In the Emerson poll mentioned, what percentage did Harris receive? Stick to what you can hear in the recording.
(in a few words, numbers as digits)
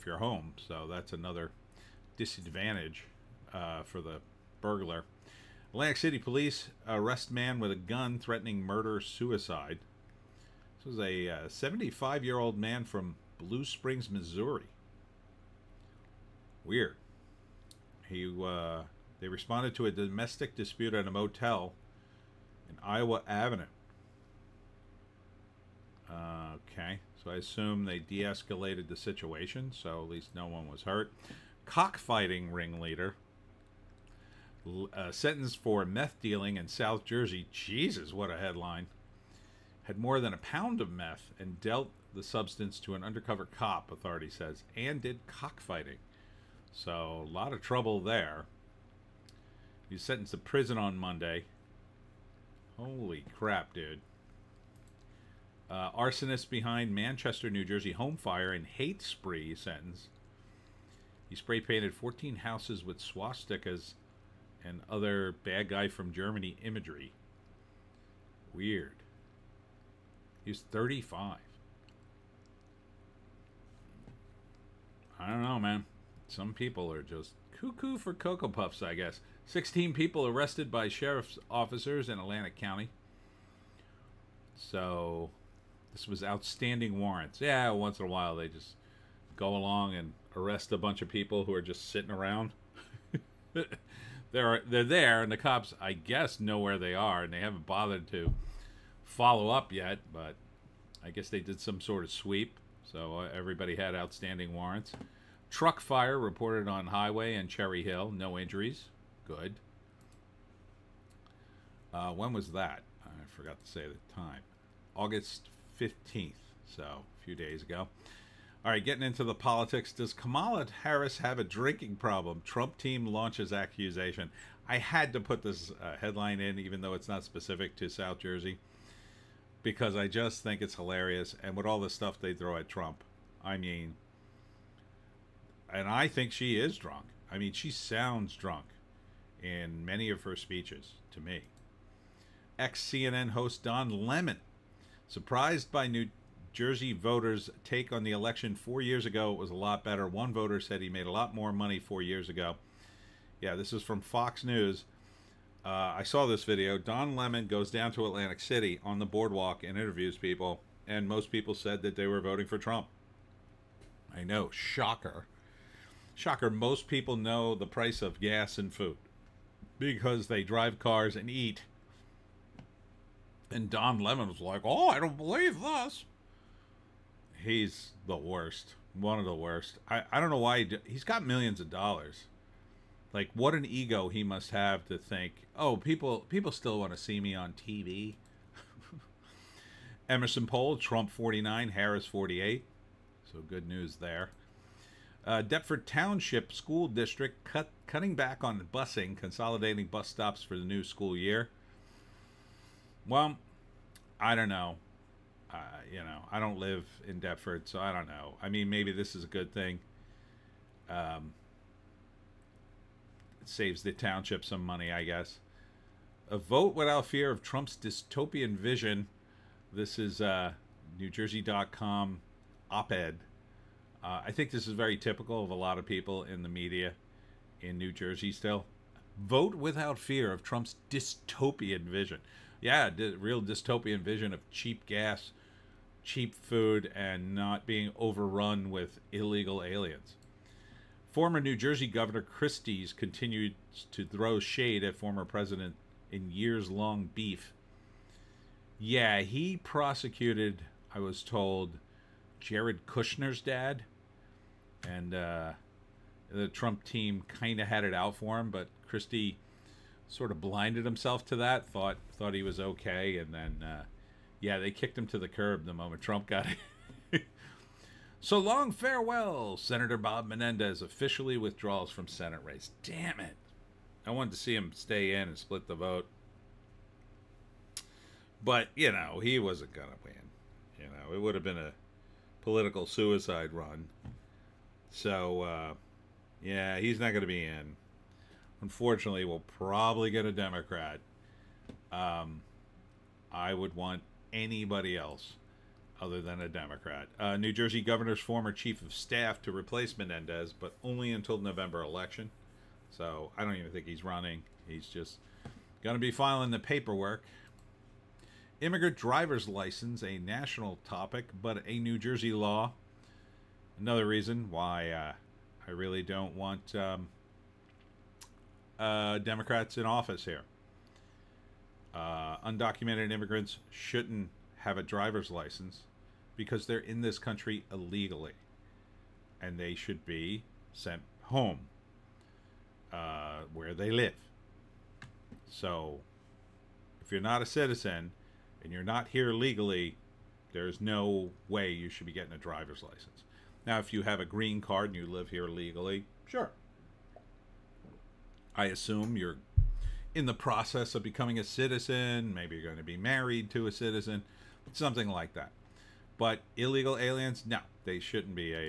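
48.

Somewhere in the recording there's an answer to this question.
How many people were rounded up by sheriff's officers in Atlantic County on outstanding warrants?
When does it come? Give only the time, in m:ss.
1:19.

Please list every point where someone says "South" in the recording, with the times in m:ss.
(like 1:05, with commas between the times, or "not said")
0:36, 2:07.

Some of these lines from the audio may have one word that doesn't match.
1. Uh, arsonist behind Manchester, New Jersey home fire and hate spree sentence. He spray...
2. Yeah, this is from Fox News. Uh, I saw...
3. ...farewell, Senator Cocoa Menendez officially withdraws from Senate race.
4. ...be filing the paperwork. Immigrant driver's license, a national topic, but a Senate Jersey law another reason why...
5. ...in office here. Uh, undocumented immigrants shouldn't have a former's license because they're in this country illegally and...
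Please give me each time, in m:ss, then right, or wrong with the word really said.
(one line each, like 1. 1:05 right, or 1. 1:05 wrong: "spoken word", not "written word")
1. 0:55 right
2. 2:33 right
3. 4:28 wrong: "Bob", not "Cocoa"
4. 5:06 wrong: "New", not "Senate"
5. 5:19 wrong: "driver", not "former".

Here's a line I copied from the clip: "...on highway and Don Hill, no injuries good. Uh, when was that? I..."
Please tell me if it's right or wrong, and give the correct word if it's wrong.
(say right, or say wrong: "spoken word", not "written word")
wrong: "Cherry", not "Don".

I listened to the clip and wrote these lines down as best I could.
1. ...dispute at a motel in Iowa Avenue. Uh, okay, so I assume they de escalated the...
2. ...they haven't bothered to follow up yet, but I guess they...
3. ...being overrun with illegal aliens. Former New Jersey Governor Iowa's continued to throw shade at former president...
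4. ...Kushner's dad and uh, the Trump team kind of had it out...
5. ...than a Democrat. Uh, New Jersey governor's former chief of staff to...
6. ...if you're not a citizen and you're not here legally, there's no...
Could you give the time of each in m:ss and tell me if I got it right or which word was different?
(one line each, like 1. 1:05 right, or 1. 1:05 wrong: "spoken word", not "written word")
1. 0:20 right
2. 1:37 right
3. 3:57 wrong: "Christie", not "Iowa"
4. 4:12 right
5. 4:56 right
6. 5:37 right.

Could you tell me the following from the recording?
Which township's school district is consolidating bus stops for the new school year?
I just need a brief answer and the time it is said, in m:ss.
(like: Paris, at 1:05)
Deptford Township, at 3:15.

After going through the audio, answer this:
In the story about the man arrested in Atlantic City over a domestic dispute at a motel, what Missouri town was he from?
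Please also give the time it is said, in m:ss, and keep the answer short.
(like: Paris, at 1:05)
Blue Springs, at 0:13.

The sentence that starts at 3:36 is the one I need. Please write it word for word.
A vote without fear of Trump's dystopian vision.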